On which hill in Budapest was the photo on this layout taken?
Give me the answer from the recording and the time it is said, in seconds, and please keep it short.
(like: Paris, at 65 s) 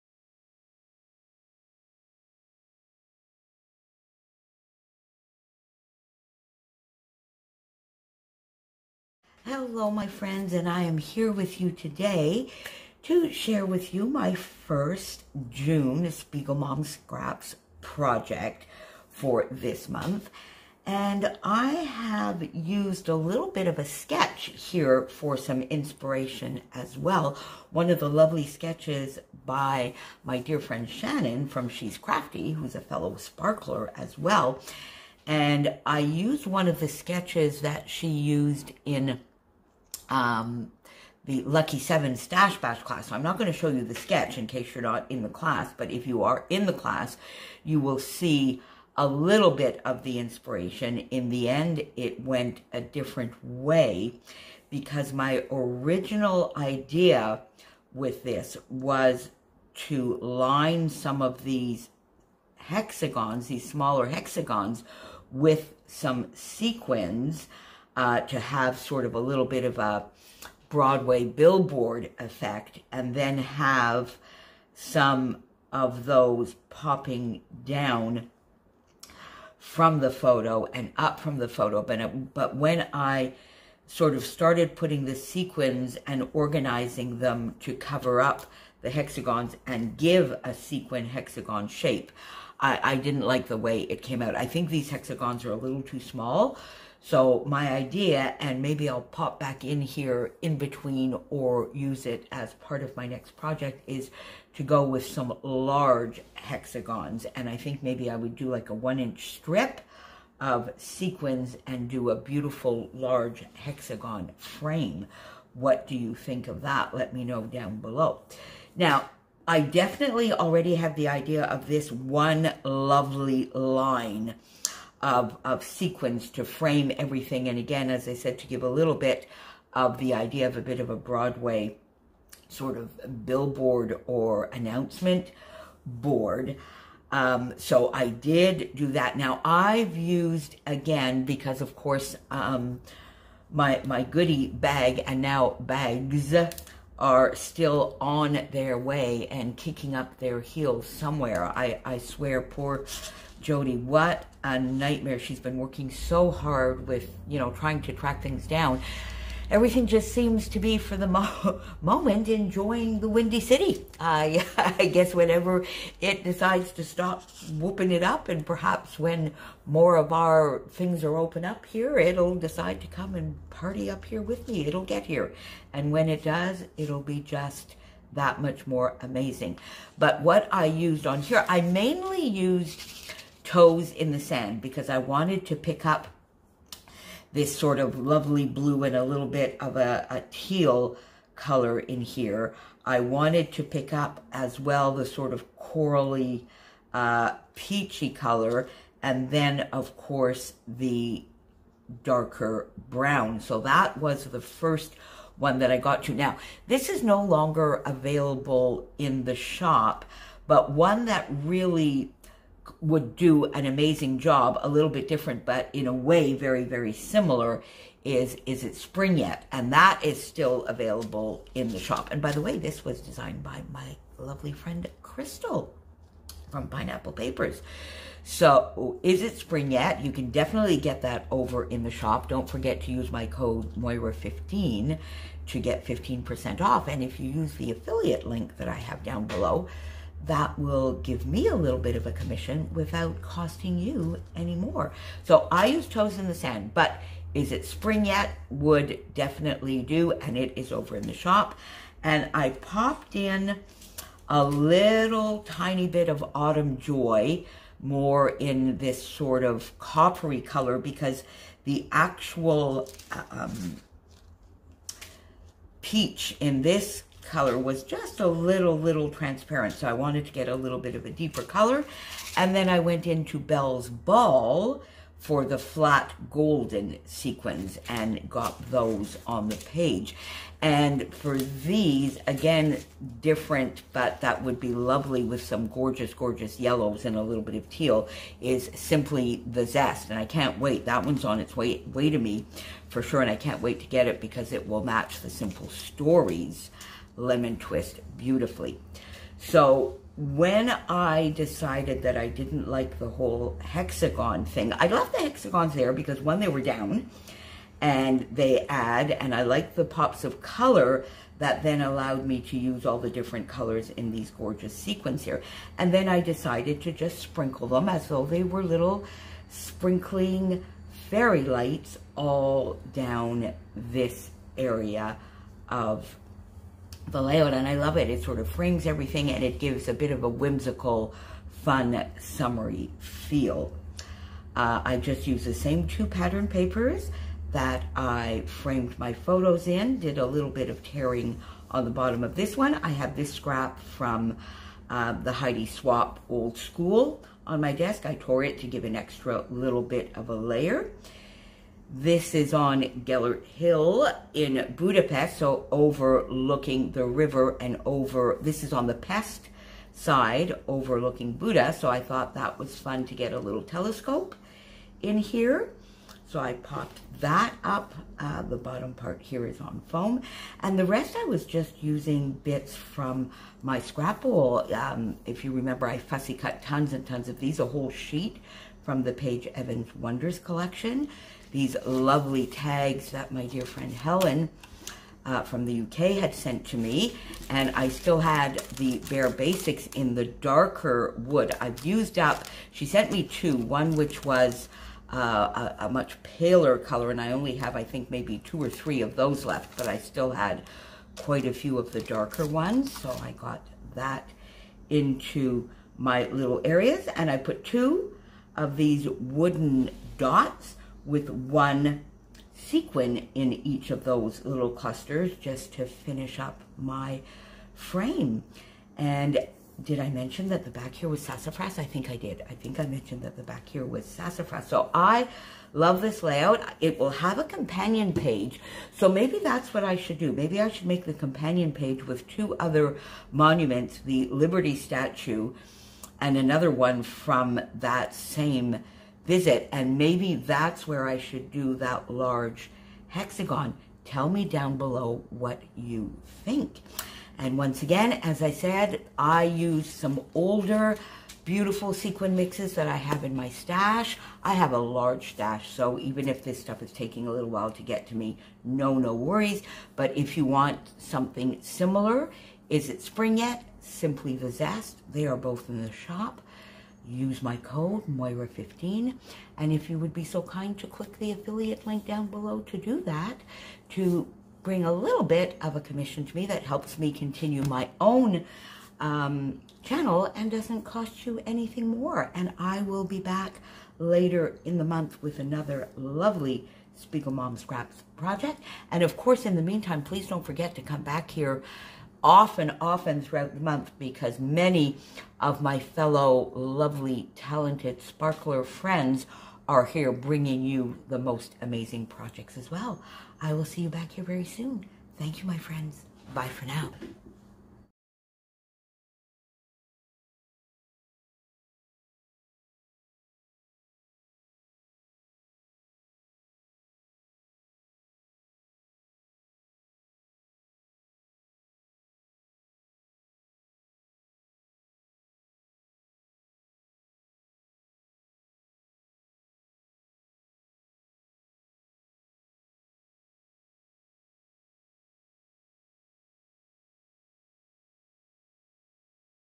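Gellert Hill, at 353 s.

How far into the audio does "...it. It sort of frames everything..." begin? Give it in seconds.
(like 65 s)
327 s.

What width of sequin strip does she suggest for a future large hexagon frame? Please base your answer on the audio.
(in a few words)
1 inch.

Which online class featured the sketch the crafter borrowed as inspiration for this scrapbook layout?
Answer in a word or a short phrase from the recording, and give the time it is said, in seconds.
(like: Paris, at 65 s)
Lucky Seven Stash Bash, at 41 s.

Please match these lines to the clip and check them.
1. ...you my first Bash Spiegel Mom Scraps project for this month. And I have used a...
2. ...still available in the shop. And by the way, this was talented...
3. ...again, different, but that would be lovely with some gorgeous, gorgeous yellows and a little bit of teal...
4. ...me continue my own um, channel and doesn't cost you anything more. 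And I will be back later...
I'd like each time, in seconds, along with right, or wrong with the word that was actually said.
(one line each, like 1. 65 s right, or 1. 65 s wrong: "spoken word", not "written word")
1. 13 s wrong: "June", not "Bash"
2. 220 s wrong: "designed", not "talented"
3. 282 s right
4. 476 s right.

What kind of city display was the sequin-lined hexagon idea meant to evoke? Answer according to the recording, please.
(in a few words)
Broadway billboard.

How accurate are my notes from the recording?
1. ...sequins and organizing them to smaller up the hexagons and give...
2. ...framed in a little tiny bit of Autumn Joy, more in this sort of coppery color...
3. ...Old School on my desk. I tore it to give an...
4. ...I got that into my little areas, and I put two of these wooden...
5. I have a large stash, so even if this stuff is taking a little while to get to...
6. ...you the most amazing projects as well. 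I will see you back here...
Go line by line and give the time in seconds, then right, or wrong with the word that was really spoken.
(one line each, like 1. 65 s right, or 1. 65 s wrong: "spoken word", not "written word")
1. 85 s wrong: "cover", not "smaller"
2. 252 s wrong: "popped", not "framed"
3. 346 s right
4. 403 s right
5. 454 s right
6. 500 s right.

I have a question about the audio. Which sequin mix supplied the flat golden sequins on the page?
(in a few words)
Bell's Ball.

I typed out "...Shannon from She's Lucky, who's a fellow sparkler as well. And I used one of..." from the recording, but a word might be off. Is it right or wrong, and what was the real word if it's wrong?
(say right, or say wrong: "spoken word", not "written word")
wrong: "Crafty", not "Lucky".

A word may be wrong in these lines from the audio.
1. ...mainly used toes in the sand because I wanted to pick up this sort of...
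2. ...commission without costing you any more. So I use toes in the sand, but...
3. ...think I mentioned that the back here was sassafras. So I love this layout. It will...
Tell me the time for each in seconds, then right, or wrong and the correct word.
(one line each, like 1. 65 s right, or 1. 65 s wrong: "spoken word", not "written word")
1. 181 s right
2. 242 s right
3. 422 s right.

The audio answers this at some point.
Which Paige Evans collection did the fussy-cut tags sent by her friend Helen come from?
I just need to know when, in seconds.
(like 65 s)
379 s.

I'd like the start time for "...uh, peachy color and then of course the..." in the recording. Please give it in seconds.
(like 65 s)
196 s.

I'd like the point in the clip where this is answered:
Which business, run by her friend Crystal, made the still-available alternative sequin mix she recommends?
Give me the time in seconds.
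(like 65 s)
226 s.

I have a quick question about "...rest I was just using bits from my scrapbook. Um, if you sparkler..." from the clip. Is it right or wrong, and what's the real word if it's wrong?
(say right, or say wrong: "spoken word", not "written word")
wrong: "remember", not "sparkler".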